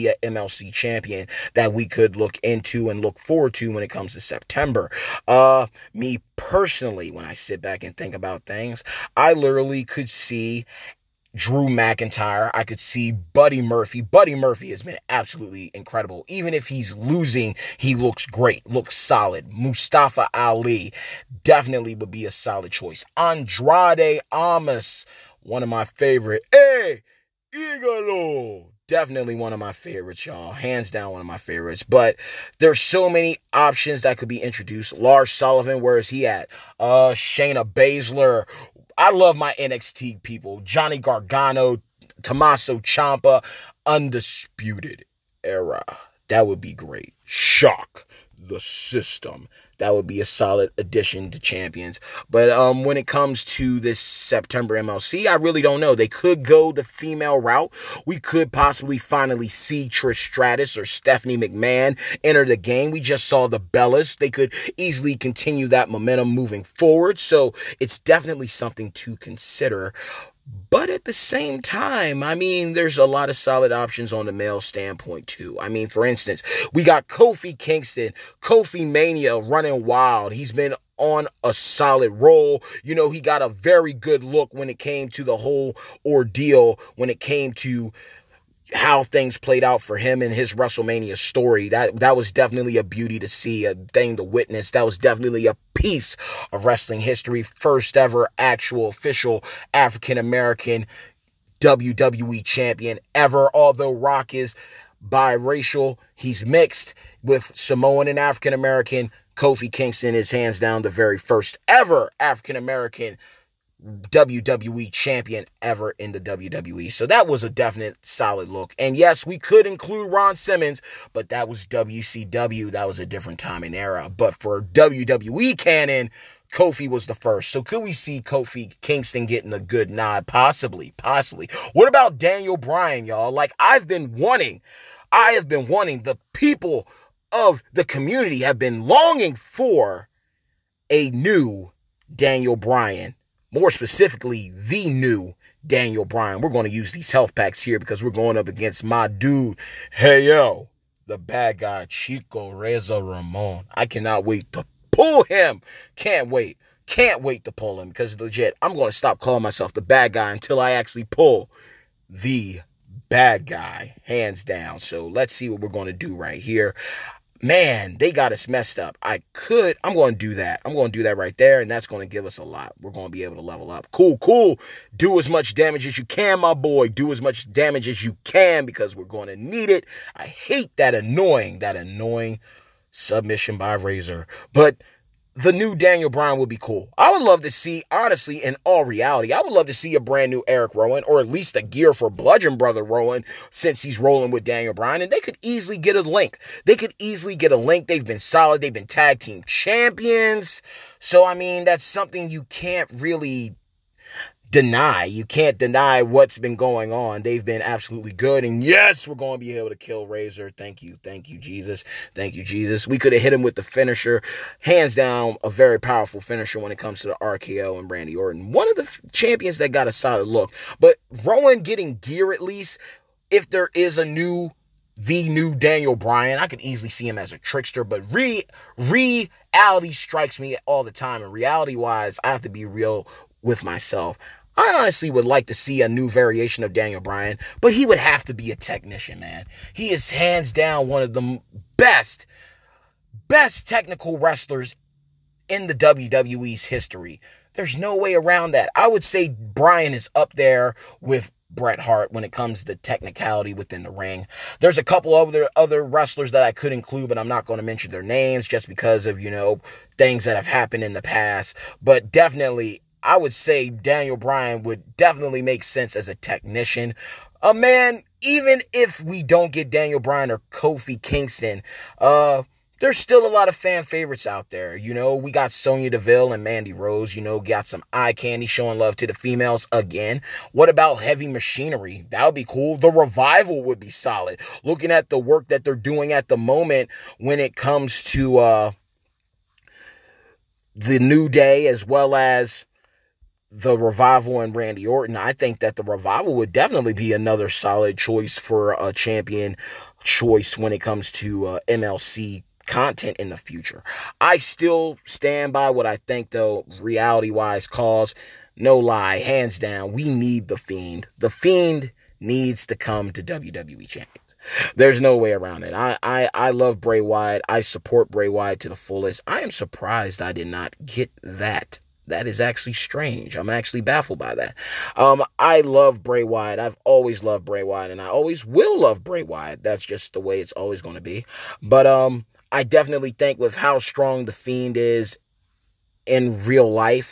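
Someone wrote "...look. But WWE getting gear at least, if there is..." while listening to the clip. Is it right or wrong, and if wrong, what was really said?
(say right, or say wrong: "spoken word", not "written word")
wrong: "Rowan", not "WWE".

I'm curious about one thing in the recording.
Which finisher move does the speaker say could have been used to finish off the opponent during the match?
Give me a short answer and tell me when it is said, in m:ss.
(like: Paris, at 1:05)
RKO, at 3:37.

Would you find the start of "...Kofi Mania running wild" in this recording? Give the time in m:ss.
1:18.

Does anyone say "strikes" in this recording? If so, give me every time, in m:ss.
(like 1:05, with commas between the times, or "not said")
3:49.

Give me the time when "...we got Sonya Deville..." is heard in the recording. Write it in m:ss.
4:35.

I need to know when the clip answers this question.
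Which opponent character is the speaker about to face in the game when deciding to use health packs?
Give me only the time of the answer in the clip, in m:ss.
2:31.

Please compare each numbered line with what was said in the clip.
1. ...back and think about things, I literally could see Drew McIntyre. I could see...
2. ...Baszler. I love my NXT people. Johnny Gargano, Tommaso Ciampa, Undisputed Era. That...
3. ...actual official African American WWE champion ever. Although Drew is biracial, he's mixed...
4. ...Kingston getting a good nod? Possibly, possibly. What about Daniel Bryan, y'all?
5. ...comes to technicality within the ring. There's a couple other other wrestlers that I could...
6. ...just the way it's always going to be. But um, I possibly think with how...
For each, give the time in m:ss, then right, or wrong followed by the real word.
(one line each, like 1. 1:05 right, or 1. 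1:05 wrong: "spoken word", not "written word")
1. 0:07 right
2. 0:37 right
3. 1:38 wrong: "Rock", not "Drew"
4. 2:08 right
5. 4:12 right
6. 5:29 wrong: "definitely", not "possibly".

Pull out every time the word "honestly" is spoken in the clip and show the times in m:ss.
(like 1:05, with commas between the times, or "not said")
3:07, 3:54.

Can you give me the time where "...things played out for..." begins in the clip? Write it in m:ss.
1:29.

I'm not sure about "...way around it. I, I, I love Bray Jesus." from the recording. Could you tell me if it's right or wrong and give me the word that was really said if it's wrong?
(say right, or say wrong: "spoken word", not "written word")
wrong: "Wyatt", not "Jesus".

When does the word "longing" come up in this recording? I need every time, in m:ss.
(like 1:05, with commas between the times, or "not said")
2:18.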